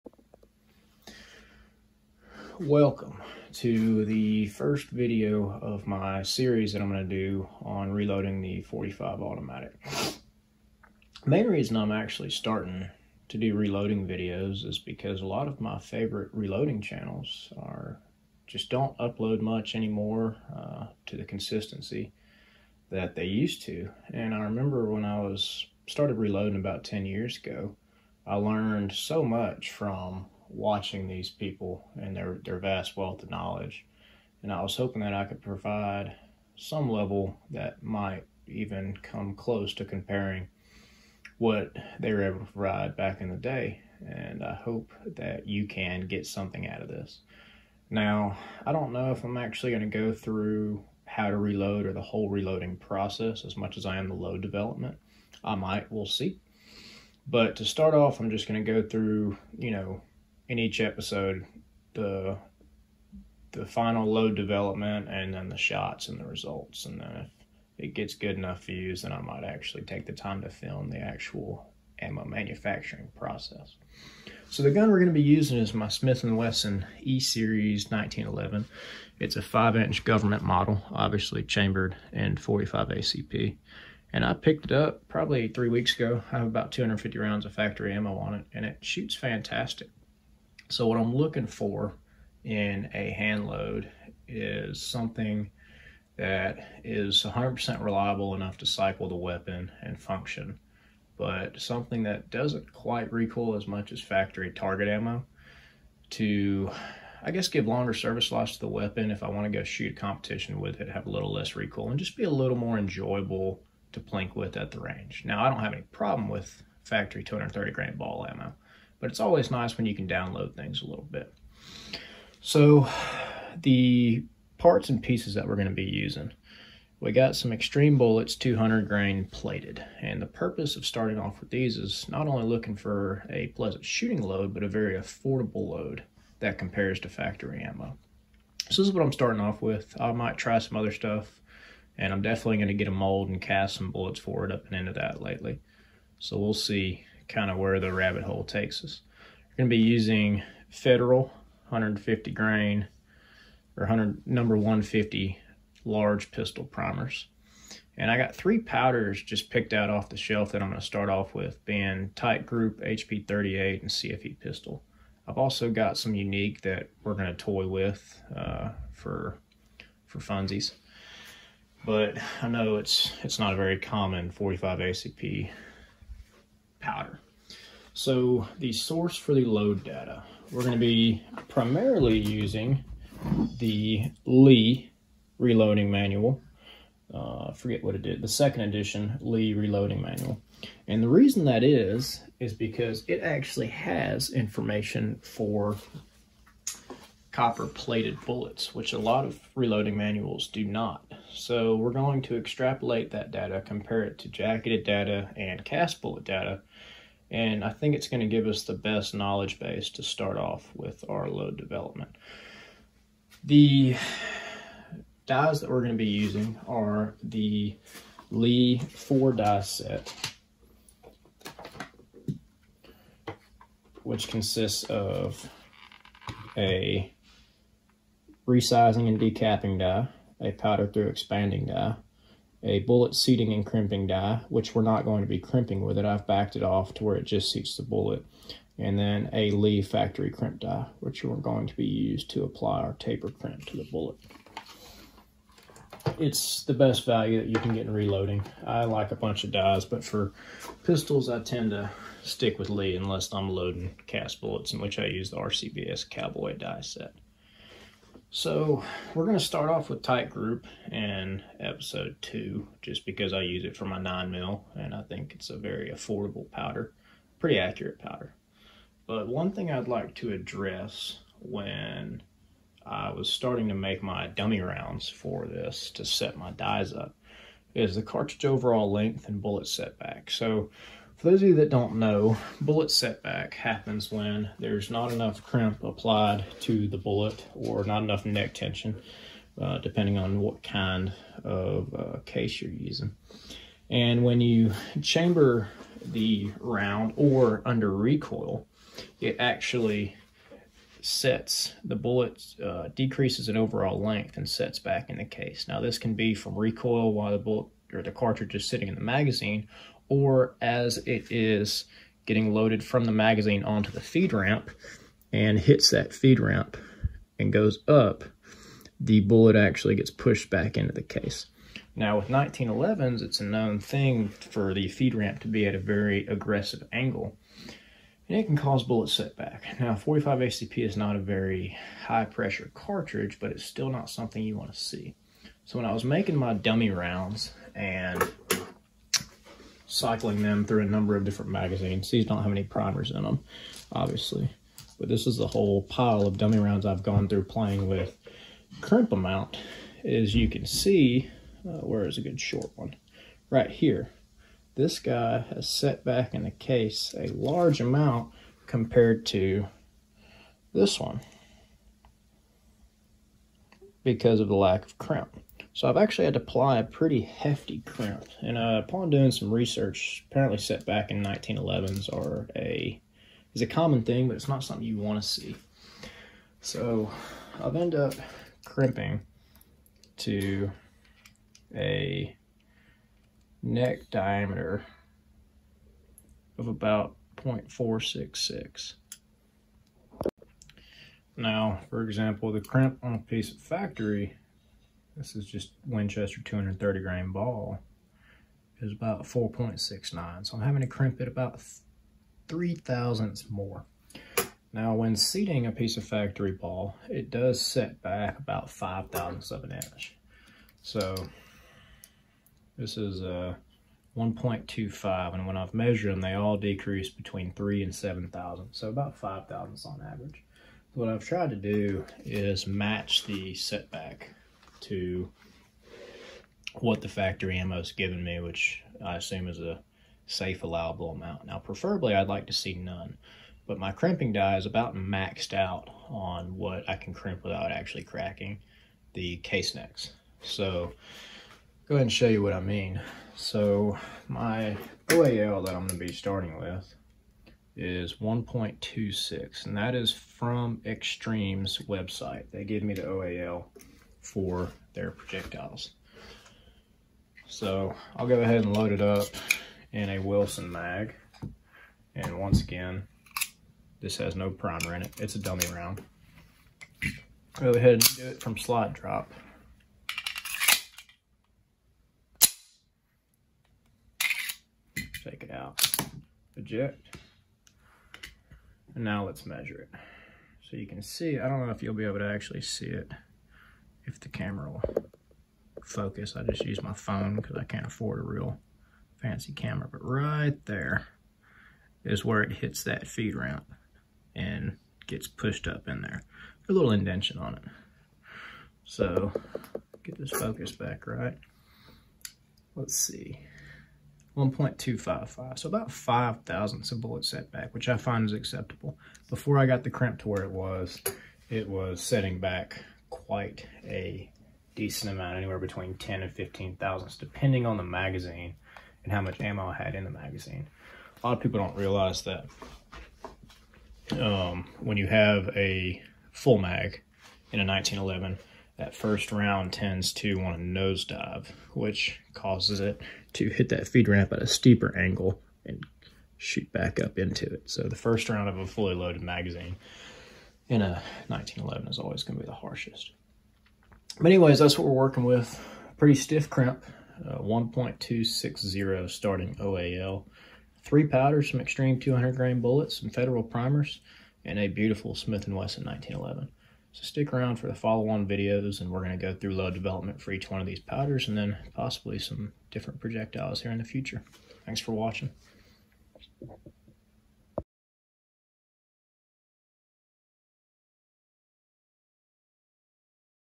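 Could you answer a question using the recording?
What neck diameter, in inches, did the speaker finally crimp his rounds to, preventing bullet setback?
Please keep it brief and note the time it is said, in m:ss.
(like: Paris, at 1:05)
0.466, at 6:27.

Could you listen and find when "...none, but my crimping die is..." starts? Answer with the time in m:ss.
7:12.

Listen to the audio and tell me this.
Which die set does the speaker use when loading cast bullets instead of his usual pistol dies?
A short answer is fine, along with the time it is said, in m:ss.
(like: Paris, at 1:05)
RCBS Cowboy, at 4:15.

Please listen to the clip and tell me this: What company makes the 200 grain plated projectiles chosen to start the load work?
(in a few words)
Xtreme Bullets.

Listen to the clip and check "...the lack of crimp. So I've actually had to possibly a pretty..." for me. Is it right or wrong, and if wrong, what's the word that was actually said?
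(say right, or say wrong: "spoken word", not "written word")
wrong: "apply", not "possibly".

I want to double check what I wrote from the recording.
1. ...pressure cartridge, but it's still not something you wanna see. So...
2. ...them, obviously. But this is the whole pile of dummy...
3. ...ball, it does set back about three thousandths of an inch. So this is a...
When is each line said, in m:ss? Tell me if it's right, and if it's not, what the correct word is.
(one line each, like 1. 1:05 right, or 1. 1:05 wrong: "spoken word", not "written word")
1. 5:32 right
2. 5:43 right
3. 6:46 wrong: "five", not "three".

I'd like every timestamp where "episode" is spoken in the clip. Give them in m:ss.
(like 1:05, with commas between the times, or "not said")
1:00, 4:21.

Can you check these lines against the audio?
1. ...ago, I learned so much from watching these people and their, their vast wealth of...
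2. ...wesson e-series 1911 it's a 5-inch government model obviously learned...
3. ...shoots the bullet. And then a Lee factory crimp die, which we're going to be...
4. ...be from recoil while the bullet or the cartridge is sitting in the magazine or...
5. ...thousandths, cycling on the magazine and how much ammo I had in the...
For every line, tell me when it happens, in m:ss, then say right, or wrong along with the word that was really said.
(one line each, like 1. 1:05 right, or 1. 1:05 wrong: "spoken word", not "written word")
1. 0:27 right
2. 1:16 wrong: "chambered", not "learned"
3. 3:57 wrong: "seats", not "shoots"
4. 5:06 right
5. 8:36 wrong: "depending", not "cycling".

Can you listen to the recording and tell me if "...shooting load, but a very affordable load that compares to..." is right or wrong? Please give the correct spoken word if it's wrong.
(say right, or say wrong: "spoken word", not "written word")
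right.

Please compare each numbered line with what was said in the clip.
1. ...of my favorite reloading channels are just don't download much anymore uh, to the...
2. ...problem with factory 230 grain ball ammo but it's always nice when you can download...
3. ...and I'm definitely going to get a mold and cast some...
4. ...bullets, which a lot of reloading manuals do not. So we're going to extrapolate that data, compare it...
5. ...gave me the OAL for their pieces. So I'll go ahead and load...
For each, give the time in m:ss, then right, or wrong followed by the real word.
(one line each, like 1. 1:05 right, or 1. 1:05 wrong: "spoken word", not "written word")
1. 0:15 wrong: "upload", not "download"
2. 1:55 right
3. 2:21 right
4. 3:18 right
5. 7:32 wrong: "projectiles", not "pieces".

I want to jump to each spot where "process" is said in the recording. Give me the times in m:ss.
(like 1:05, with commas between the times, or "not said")
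0:52, 1:13.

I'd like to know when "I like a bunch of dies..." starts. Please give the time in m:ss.
4:08.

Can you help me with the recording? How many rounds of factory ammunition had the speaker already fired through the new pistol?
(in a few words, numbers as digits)
250.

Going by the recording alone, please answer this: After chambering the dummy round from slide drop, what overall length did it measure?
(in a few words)
1.255.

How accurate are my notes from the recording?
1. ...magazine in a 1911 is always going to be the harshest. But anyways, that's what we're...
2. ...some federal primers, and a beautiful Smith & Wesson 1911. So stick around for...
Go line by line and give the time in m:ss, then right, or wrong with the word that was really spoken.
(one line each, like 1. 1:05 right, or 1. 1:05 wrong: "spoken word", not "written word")
1. 8:59 right
2. 9:13 right.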